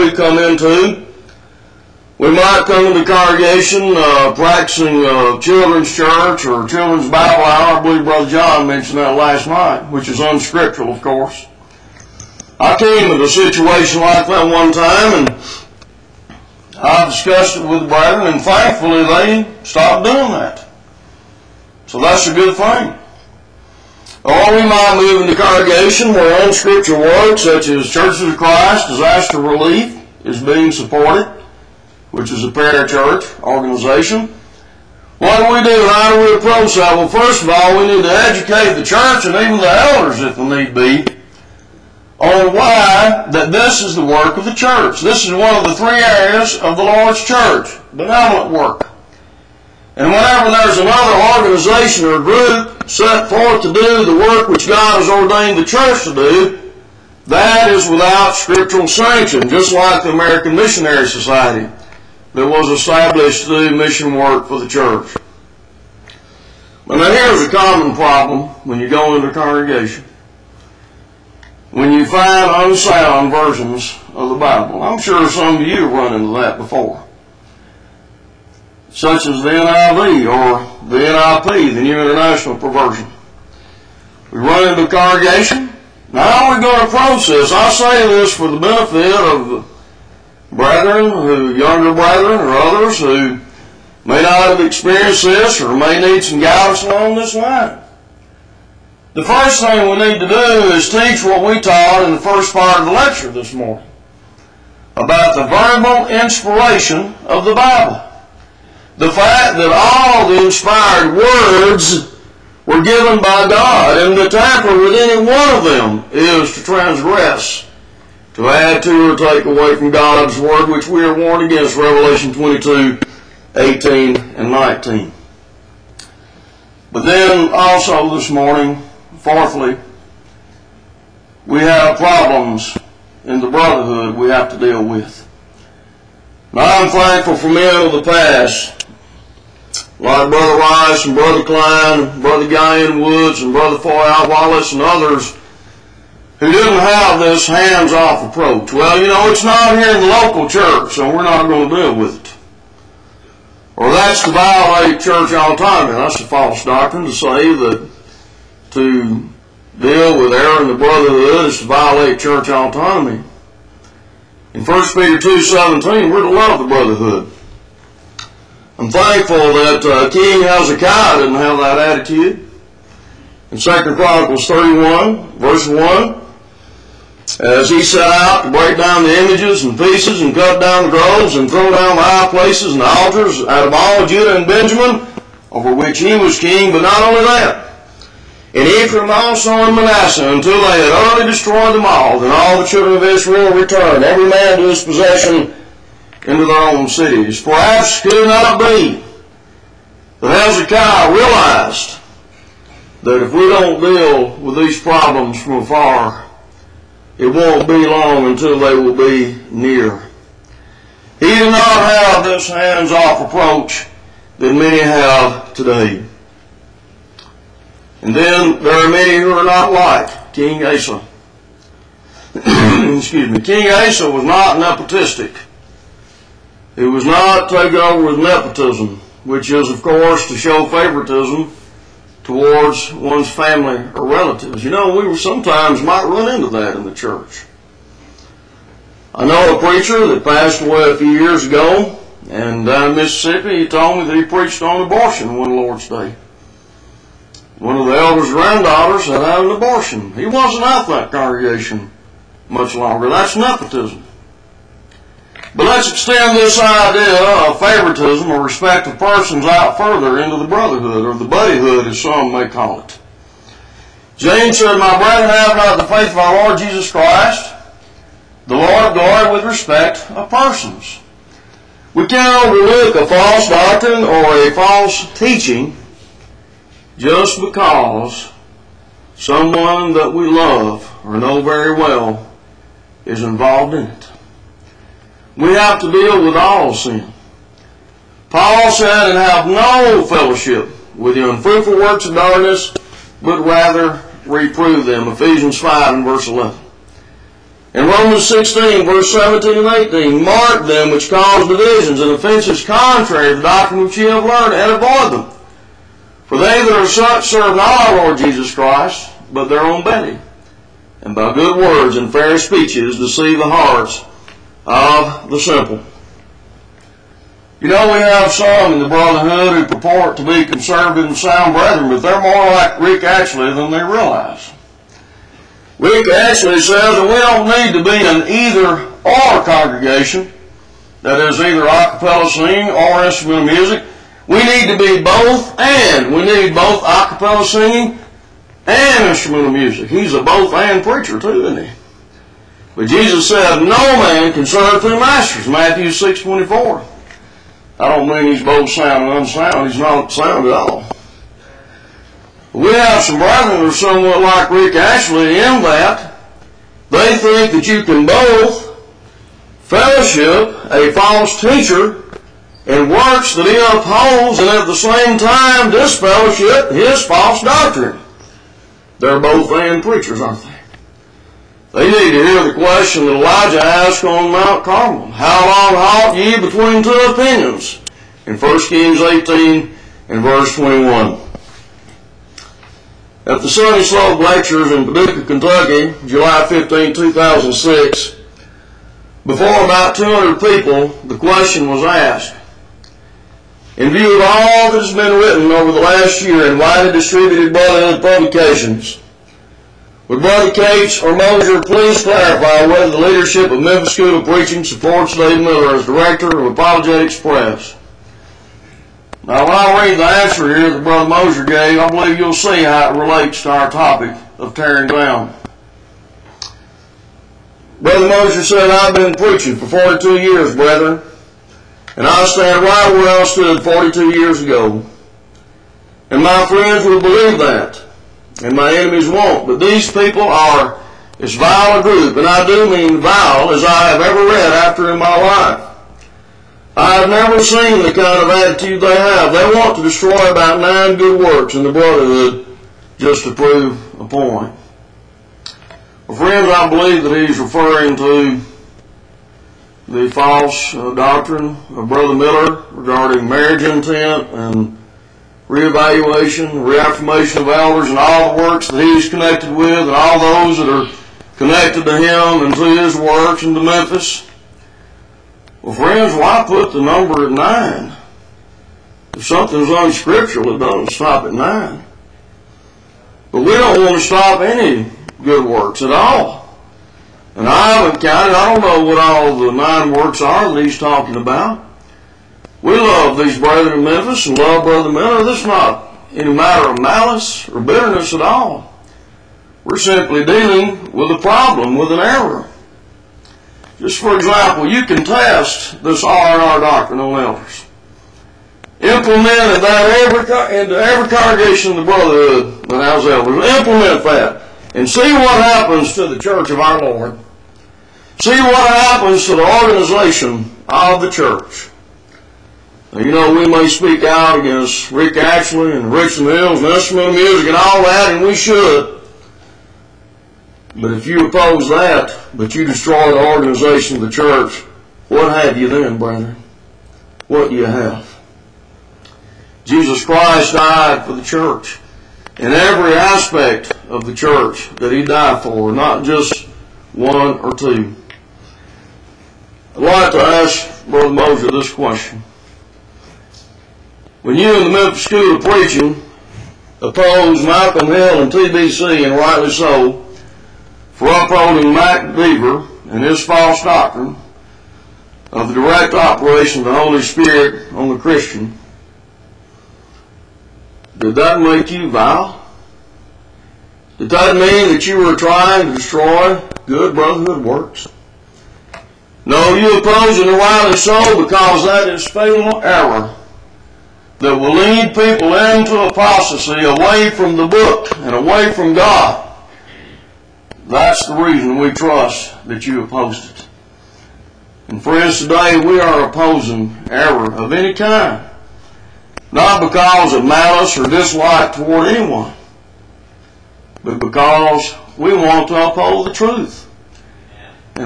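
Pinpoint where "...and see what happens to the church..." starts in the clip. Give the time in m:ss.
8:24.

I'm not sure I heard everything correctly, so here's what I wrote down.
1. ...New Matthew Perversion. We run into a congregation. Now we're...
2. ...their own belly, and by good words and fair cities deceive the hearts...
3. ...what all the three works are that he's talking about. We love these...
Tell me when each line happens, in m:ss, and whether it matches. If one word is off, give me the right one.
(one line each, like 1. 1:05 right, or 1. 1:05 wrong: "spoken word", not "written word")
1. 1:21 wrong: "International", not "Matthew"
2. 5:09 wrong: "speeches", not "cities"
3. 7:58 wrong: "nine", not "three".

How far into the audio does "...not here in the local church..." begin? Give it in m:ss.
2:29.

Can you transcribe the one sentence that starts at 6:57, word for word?
Brother Mosher said, I've been preaching for 42 years, brethren and I stand right where I stood 42 years ago.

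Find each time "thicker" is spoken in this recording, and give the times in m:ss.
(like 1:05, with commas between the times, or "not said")
not said.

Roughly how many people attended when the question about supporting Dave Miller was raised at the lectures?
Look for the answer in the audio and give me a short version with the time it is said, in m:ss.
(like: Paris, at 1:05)
200, at 6:29.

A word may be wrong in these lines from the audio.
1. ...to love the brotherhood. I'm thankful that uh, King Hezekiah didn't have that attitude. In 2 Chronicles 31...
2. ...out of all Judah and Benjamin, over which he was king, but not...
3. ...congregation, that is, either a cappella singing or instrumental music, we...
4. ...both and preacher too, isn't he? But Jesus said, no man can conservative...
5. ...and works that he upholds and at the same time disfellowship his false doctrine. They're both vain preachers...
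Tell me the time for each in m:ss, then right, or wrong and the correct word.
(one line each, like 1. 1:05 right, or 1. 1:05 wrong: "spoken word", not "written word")
1. 2:46 right
2. 3:03 right
3. 5:29 right
4. 5:40 wrong: "serve", not "conservative"
5. 6:02 right.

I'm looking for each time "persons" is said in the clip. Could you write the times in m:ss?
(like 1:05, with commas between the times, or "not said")
4:18, 4:30.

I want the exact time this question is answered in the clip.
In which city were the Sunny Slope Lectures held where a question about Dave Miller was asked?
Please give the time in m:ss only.
6:24.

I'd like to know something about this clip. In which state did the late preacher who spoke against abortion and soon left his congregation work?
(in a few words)
Mississippi.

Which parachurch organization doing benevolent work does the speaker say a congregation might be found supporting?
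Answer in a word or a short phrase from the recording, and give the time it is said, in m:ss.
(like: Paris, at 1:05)
Churches of Christ Disaster Relief, at 0:27.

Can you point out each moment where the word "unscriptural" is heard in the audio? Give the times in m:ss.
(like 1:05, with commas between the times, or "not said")
0:10, 0:26, 7:49.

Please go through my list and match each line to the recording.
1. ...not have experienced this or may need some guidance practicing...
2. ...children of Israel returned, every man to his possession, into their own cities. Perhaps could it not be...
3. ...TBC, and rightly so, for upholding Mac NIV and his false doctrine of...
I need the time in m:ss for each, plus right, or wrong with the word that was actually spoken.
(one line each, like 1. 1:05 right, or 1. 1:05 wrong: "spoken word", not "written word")
1. 1:34 wrong: "along", not "practicing"
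2. 3:12 right
3. 9:08 wrong: "Deaver", not "NIV".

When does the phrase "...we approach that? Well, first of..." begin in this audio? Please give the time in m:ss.
0:36.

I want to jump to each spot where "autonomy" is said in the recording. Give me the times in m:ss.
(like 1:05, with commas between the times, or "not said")
2:35, 2:42.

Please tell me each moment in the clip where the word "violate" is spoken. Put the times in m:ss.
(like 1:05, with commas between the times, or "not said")
2:34, 2:41.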